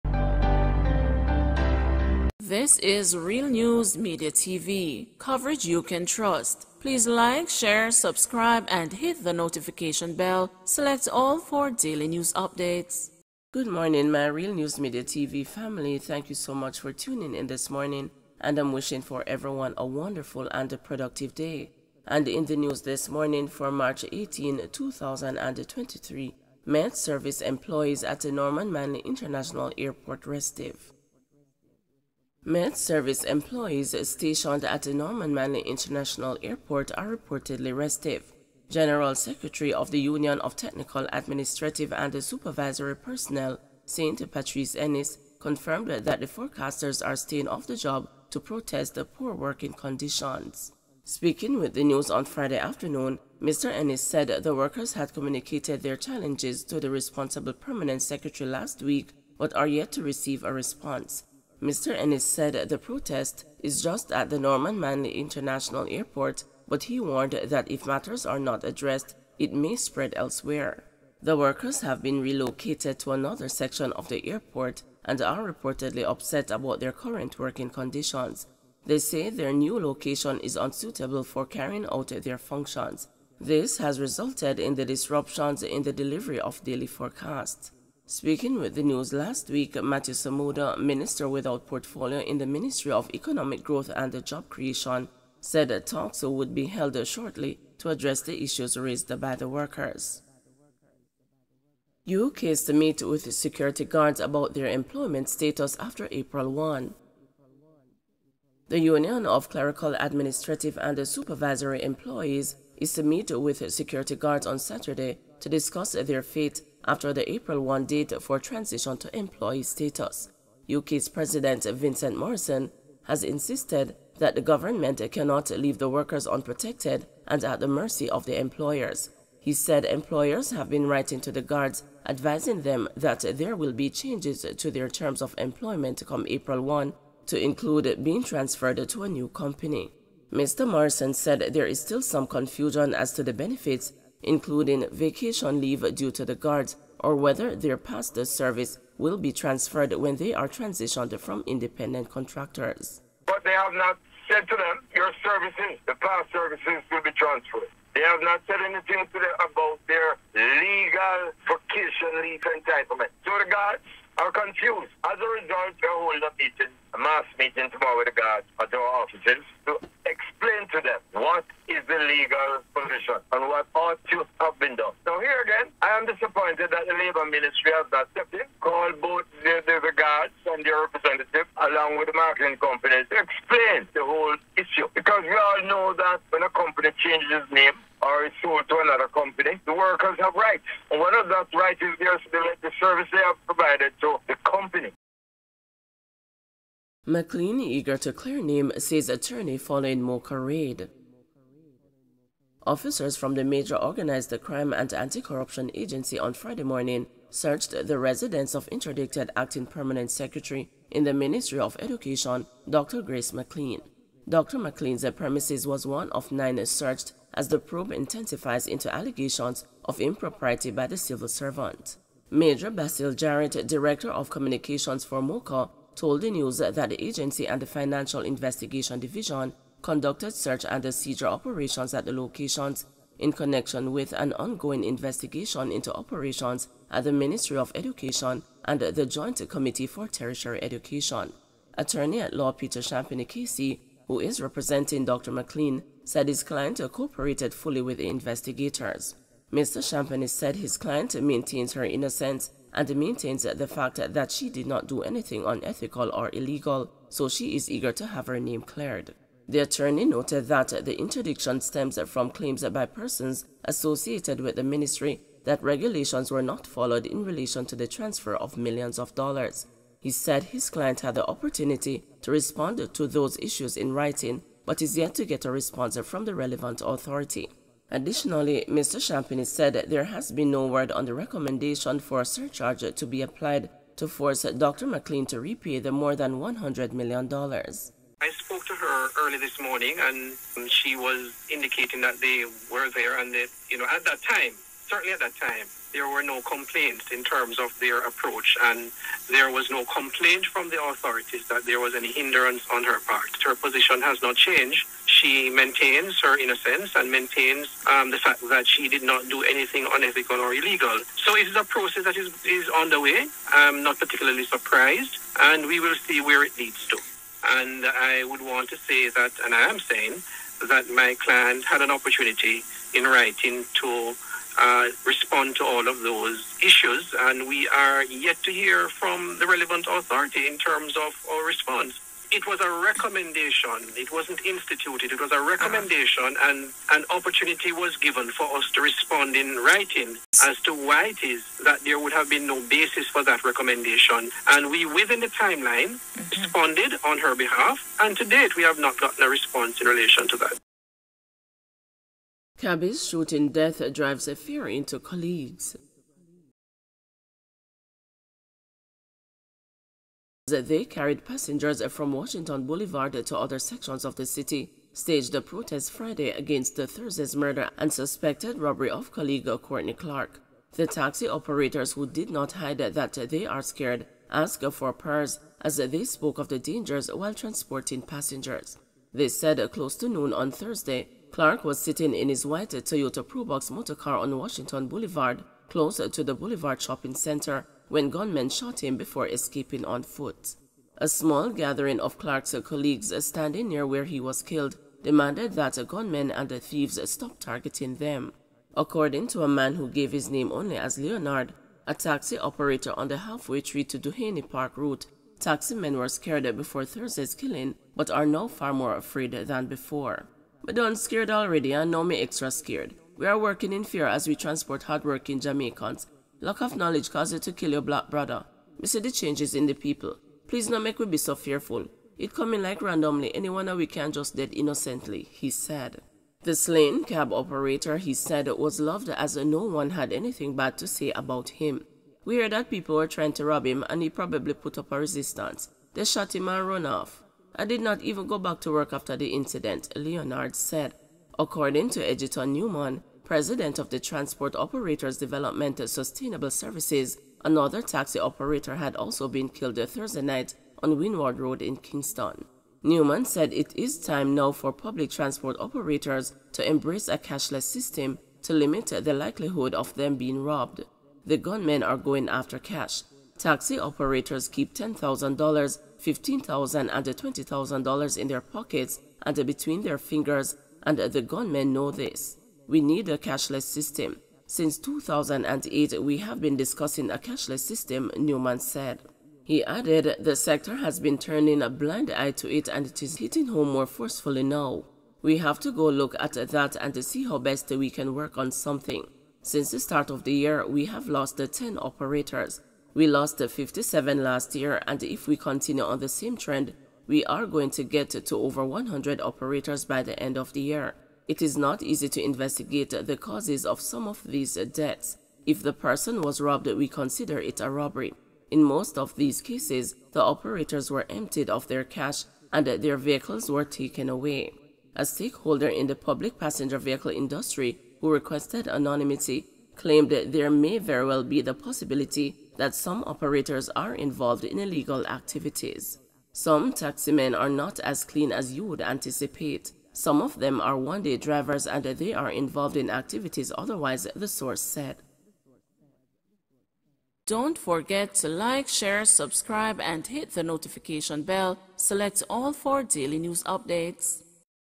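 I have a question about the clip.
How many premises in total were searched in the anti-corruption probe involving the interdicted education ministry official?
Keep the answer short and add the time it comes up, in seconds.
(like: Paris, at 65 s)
9, at 216 s.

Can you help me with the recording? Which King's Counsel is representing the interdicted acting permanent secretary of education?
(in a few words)
Peter Champagnie.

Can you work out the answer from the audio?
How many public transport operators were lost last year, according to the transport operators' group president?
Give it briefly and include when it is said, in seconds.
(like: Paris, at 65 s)
57, at 493 s.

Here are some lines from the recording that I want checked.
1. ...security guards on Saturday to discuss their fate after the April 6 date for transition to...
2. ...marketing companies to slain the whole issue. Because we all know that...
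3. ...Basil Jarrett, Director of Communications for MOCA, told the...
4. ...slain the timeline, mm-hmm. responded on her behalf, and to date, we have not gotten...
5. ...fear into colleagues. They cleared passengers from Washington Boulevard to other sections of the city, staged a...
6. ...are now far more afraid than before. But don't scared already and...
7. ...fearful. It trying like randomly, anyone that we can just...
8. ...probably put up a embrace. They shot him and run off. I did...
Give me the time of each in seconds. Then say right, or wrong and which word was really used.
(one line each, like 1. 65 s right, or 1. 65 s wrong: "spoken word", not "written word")
1. 113 s wrong: "1", not "6"
2. 182 s wrong: "explain", not "slain"
3. 222 s right
4. 344 s wrong: "within", not "slain"
5. 354 s wrong: "carried", not "cleared"
6. 408 s right
7. 421 s wrong: "coming", not "trying"
8. 434 s wrong: "resistance", not "embrace".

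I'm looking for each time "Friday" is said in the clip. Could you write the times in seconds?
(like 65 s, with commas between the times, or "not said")
52 s, 206 s, 365 s.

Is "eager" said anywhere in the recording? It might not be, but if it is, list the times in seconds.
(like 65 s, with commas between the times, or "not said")
197 s, 257 s.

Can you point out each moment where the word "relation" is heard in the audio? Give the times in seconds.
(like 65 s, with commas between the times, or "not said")
267 s, 349 s.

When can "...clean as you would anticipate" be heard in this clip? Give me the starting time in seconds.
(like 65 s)
528 s.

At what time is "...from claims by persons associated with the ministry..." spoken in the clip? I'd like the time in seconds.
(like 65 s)
262 s.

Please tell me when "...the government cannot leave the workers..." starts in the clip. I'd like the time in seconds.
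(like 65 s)
124 s.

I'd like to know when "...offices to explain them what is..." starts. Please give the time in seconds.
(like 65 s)
169 s.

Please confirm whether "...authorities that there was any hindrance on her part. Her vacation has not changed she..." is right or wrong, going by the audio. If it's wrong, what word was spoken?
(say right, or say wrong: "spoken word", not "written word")
wrong: "position", not "vacation".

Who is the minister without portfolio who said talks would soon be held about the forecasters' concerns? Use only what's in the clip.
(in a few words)
Matthew Samuda.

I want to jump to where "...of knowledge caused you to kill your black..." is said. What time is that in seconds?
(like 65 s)
416 s.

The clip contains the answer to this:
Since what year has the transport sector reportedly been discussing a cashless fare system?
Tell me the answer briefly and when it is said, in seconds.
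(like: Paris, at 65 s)
2008, at 474 s.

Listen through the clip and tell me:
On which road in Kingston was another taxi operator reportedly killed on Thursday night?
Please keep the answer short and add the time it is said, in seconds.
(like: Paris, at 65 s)
Windward Road, at 450 s.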